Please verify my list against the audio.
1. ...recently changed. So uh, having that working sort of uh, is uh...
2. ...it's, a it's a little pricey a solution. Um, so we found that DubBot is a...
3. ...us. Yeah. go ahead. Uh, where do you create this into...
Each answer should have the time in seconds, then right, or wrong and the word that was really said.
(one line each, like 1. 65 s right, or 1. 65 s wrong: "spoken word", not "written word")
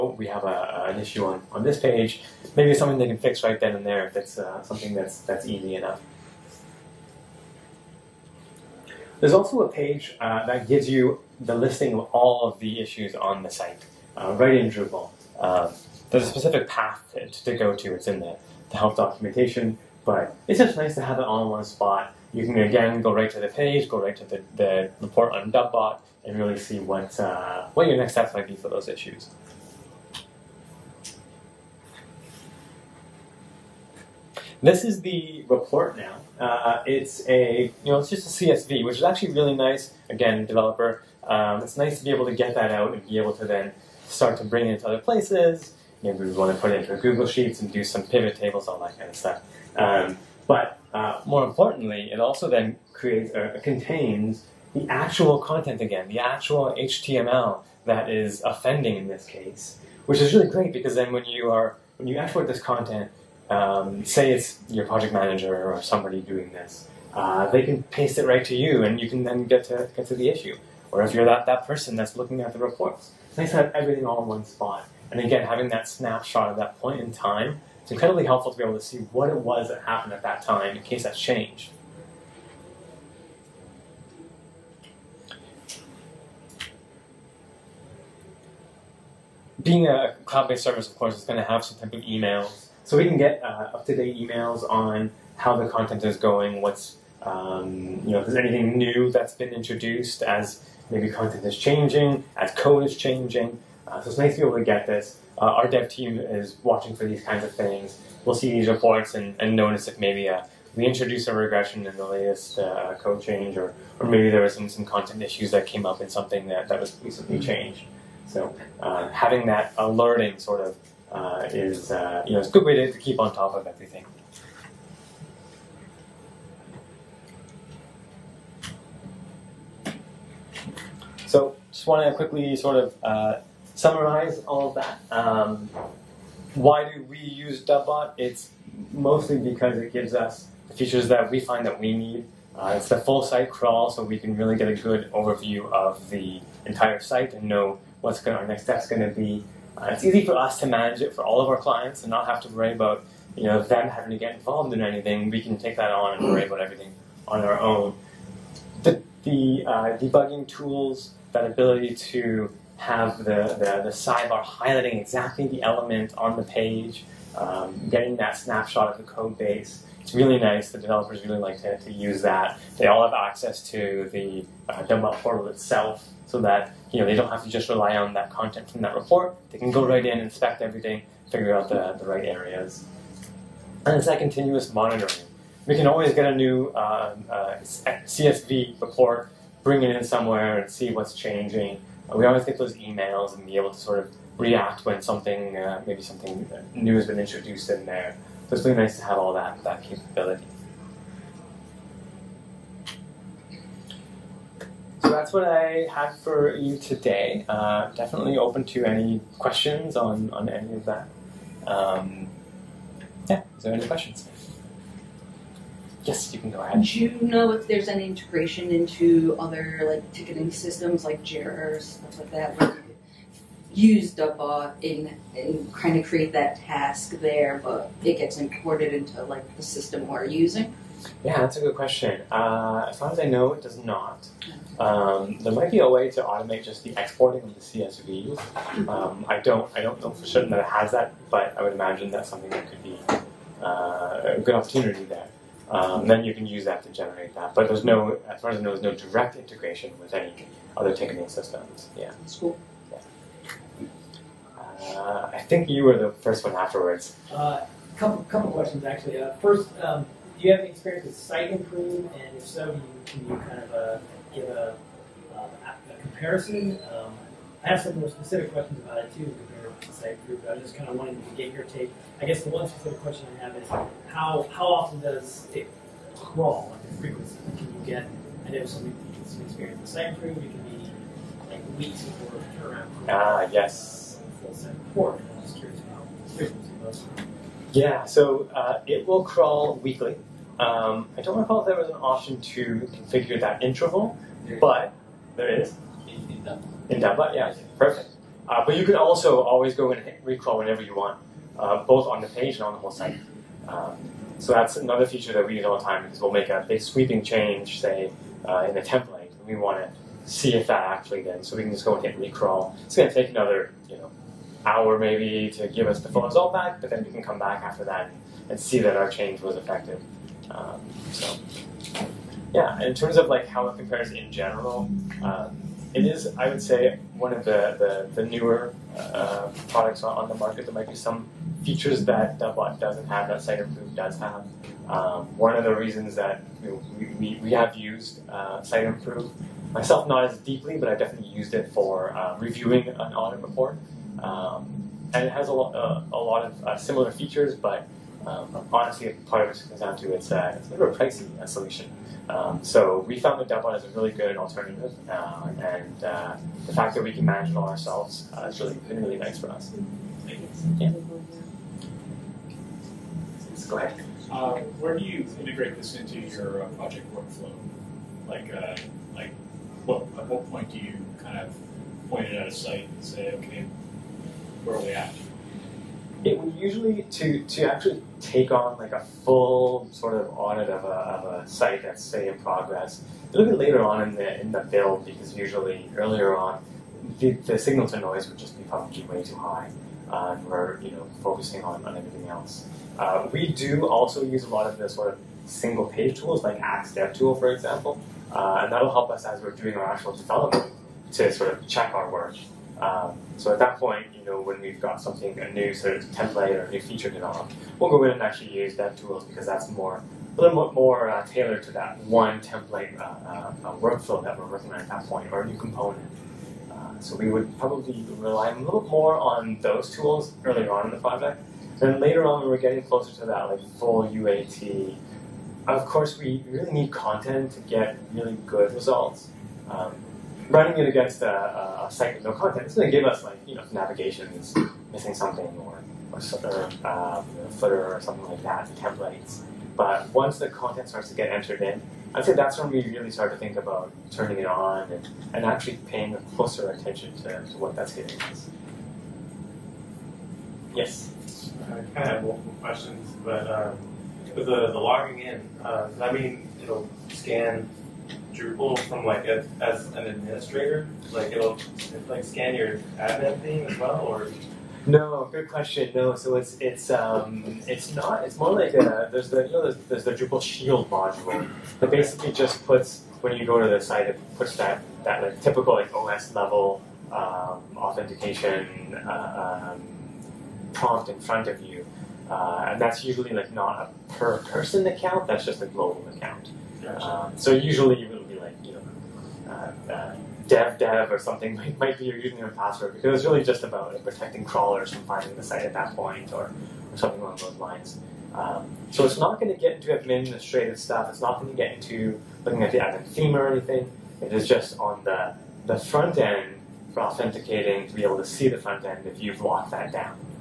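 1. 117 s wrong: "alerting", not "working"
2. 350 s right
3. 359 s wrong: "integrate", not "create".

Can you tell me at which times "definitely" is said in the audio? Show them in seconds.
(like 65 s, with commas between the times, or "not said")
207 s, 340 s.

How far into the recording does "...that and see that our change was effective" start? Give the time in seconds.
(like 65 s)
317 s.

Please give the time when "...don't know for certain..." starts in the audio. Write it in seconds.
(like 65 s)
239 s.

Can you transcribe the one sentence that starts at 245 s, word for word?
Um, then you can use that to generate that.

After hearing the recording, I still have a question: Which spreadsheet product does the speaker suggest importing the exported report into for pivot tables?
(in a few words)
Google Sheets.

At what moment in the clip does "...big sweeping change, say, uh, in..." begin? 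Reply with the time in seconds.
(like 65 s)
306 s.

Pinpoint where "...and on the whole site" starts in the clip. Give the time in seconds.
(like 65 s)
302 s.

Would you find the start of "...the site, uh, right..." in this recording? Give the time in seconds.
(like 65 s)
13 s.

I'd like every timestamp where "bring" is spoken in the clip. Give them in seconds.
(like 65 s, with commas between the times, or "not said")
44 s, 189 s.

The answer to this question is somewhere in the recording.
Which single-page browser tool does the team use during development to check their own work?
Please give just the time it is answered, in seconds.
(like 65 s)
396 s.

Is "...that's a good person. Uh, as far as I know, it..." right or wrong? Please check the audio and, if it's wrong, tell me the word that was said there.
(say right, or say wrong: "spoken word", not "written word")
wrong: "question", not "person".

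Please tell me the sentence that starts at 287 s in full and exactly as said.
Yeah, so uh, it will crawl weekly.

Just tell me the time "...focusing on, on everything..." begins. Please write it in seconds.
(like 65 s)
391 s.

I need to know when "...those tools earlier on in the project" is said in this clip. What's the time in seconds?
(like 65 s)
419 s.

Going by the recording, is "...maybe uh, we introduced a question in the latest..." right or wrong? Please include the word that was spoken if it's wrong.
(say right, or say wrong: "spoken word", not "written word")
wrong: "regression", not "question".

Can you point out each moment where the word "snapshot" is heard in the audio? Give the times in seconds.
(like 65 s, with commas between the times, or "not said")
75 s, 168 s.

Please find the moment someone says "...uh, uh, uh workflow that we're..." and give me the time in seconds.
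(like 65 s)
413 s.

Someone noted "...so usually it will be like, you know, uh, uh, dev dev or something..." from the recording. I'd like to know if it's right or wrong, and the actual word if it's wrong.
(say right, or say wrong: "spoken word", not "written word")
right.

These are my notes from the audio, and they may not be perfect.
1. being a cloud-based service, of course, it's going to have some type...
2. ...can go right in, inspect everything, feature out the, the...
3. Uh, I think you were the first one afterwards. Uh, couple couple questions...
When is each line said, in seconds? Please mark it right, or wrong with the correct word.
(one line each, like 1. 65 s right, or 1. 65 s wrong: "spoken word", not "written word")
1. 89 s right
2. 179 s wrong: "figure", not "feature"
3. 254 s right.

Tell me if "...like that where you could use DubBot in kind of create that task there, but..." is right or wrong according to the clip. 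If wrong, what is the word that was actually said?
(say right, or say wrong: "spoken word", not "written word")
right.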